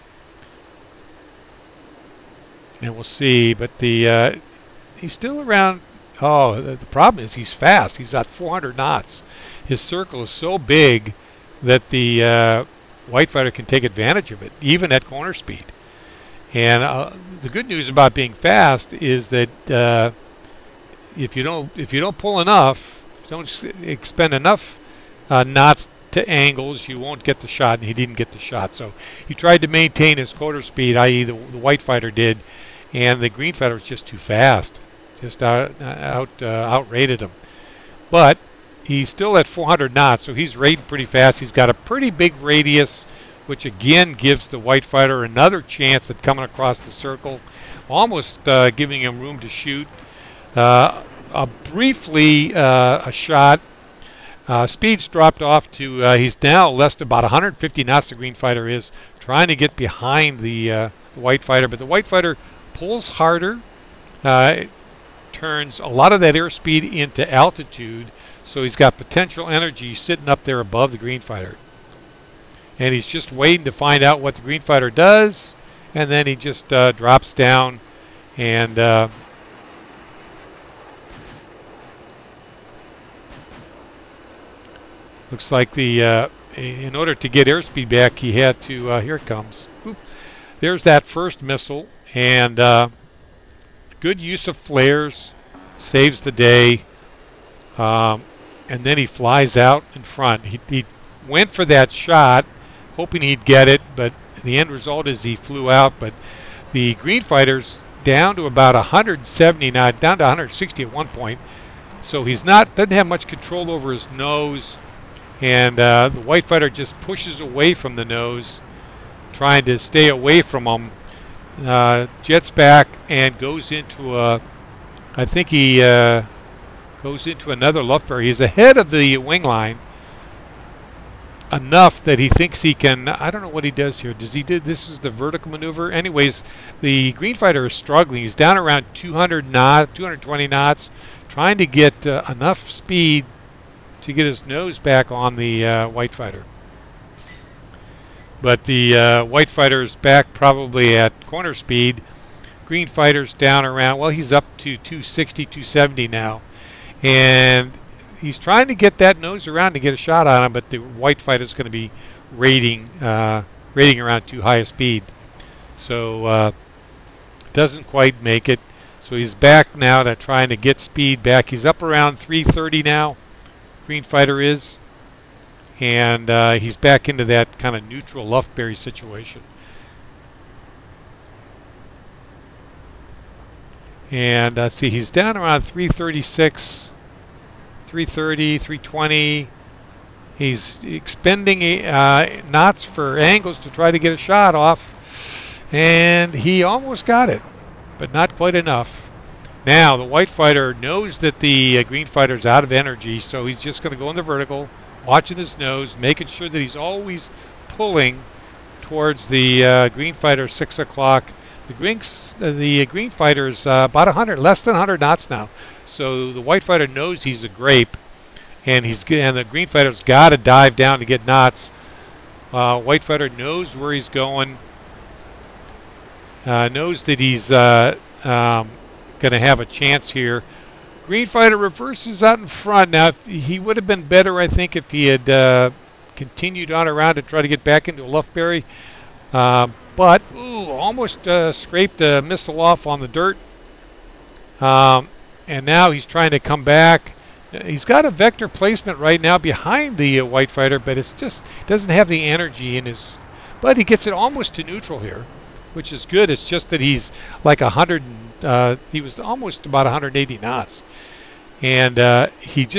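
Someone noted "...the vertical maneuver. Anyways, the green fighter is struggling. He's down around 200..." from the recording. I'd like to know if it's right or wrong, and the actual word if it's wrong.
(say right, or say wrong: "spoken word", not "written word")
right.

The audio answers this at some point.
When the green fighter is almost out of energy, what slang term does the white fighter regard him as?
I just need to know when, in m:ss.
3:37.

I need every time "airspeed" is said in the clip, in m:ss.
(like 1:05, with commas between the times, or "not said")
1:06, 1:27.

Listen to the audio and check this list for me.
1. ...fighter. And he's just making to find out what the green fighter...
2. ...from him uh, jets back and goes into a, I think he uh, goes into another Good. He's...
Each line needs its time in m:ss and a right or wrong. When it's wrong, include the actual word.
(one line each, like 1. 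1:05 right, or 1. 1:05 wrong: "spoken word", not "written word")
1. 1:11 wrong: "waiting", not "making"
2. 2:00 wrong: "Lufbery", not "Good".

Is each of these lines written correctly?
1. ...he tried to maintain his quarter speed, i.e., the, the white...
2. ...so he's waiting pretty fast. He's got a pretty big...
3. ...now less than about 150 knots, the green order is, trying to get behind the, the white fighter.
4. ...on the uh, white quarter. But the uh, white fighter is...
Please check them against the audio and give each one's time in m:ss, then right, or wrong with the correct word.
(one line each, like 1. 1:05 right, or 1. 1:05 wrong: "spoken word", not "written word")
1. 0:29 right
2. 0:40 wrong: "rating", not "waiting"
3. 0:56 wrong: "fighter", not "order"
4. 2:25 wrong: "fighter", not "quarter".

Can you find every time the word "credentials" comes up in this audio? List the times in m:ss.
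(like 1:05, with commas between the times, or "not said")
not said.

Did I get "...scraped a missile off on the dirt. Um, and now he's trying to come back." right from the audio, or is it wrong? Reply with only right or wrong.
right.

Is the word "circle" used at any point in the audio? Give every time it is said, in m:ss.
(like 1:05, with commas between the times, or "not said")
0:09, 0:46.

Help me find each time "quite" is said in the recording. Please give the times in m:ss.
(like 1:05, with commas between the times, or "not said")
2:47, 3:18.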